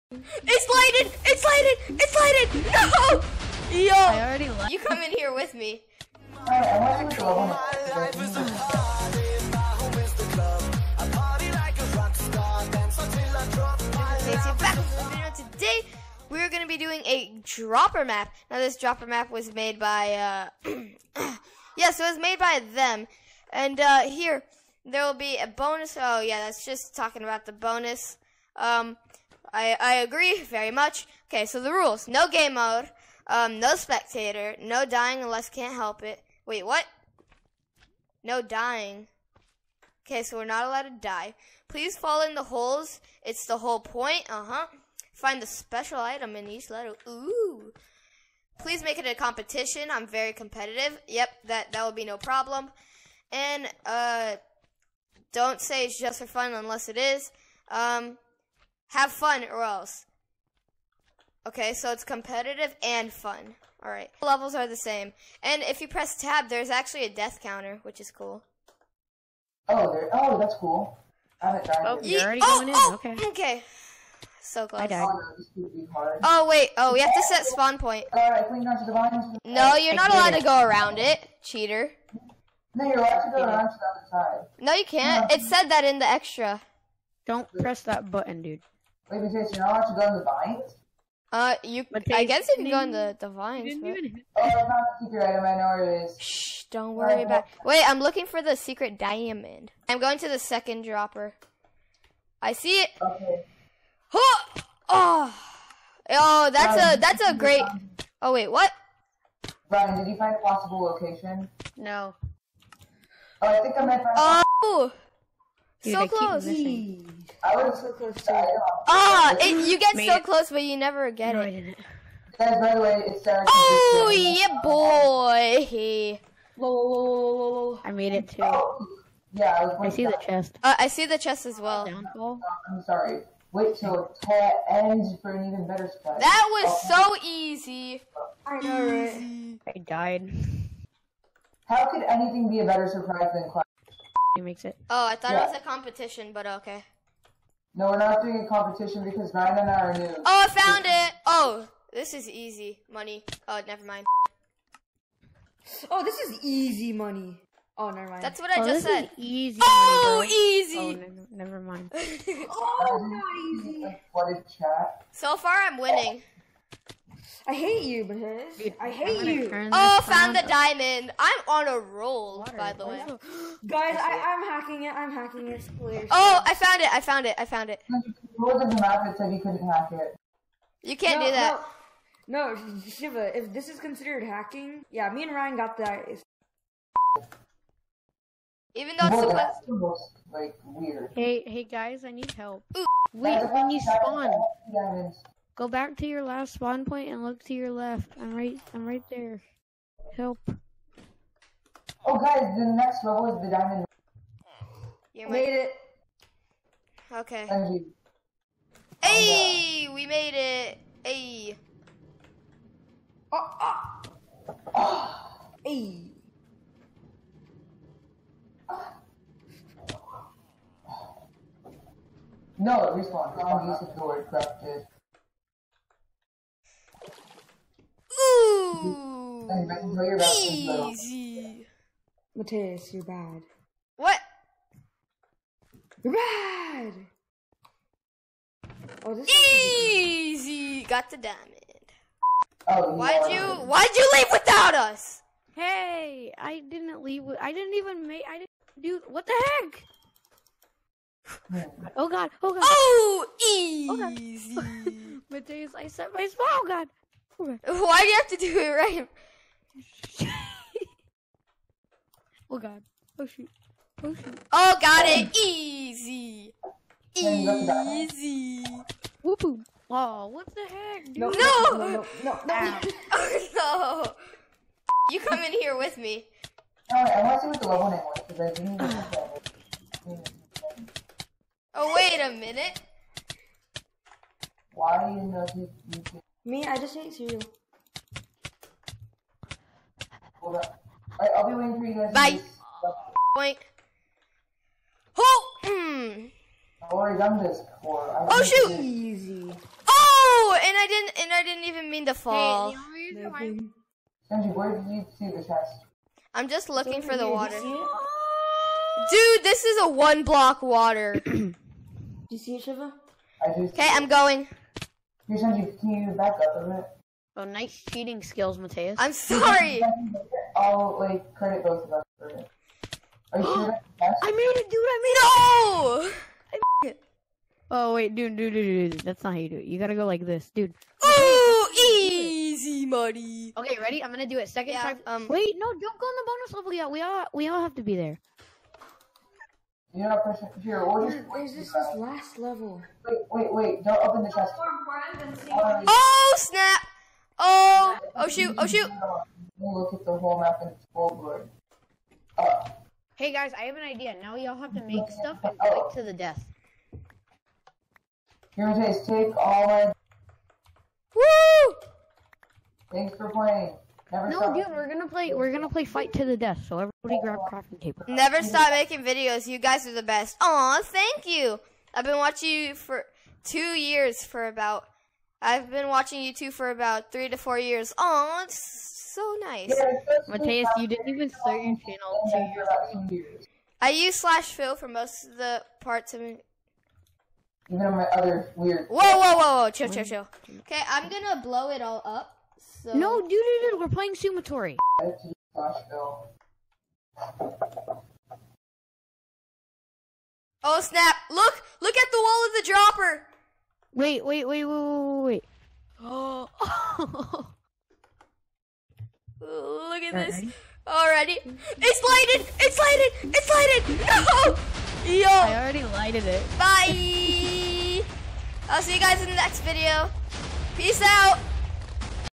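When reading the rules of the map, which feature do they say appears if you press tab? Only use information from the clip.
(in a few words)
A death counter.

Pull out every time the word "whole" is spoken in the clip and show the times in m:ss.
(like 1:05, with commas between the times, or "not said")
0:43, 5:50.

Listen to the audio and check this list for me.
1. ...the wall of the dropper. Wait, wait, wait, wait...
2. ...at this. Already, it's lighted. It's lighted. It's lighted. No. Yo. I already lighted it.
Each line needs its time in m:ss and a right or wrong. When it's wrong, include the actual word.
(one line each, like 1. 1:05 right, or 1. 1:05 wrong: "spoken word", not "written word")
1. 6:42 right
2. 6:50 right.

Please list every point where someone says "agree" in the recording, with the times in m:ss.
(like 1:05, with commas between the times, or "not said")
0:29.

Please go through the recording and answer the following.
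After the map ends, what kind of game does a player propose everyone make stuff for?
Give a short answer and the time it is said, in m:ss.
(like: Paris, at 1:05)
Fight to the death, at 6:05.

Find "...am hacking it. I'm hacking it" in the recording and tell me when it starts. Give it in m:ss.
2:54.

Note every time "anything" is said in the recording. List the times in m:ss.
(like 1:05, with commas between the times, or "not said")
2:22.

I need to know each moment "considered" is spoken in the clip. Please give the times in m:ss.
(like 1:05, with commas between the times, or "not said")
3:03.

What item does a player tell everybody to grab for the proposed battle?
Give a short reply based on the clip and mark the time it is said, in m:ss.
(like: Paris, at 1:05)
Crafting table, at 6:07.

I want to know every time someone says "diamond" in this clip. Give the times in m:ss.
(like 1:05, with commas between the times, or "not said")
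1:38, 2:50, 3:23, 4:01.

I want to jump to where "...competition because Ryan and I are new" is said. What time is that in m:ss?
2:28.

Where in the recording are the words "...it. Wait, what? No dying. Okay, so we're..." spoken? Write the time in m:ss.
0:36.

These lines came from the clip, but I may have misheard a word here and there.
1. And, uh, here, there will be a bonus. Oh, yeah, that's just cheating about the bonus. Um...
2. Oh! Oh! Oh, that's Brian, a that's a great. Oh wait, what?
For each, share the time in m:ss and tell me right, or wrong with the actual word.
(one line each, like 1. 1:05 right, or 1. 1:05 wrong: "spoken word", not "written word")
1. 0:23 wrong: "talking", not "cheating"
2. 1:44 right.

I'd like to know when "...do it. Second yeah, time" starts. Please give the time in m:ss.
5:34.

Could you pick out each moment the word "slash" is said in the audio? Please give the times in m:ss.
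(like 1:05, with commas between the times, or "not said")
6:24.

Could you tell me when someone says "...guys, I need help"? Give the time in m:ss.
3:11.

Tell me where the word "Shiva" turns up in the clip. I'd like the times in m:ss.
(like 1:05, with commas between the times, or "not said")
3:02, 5:12.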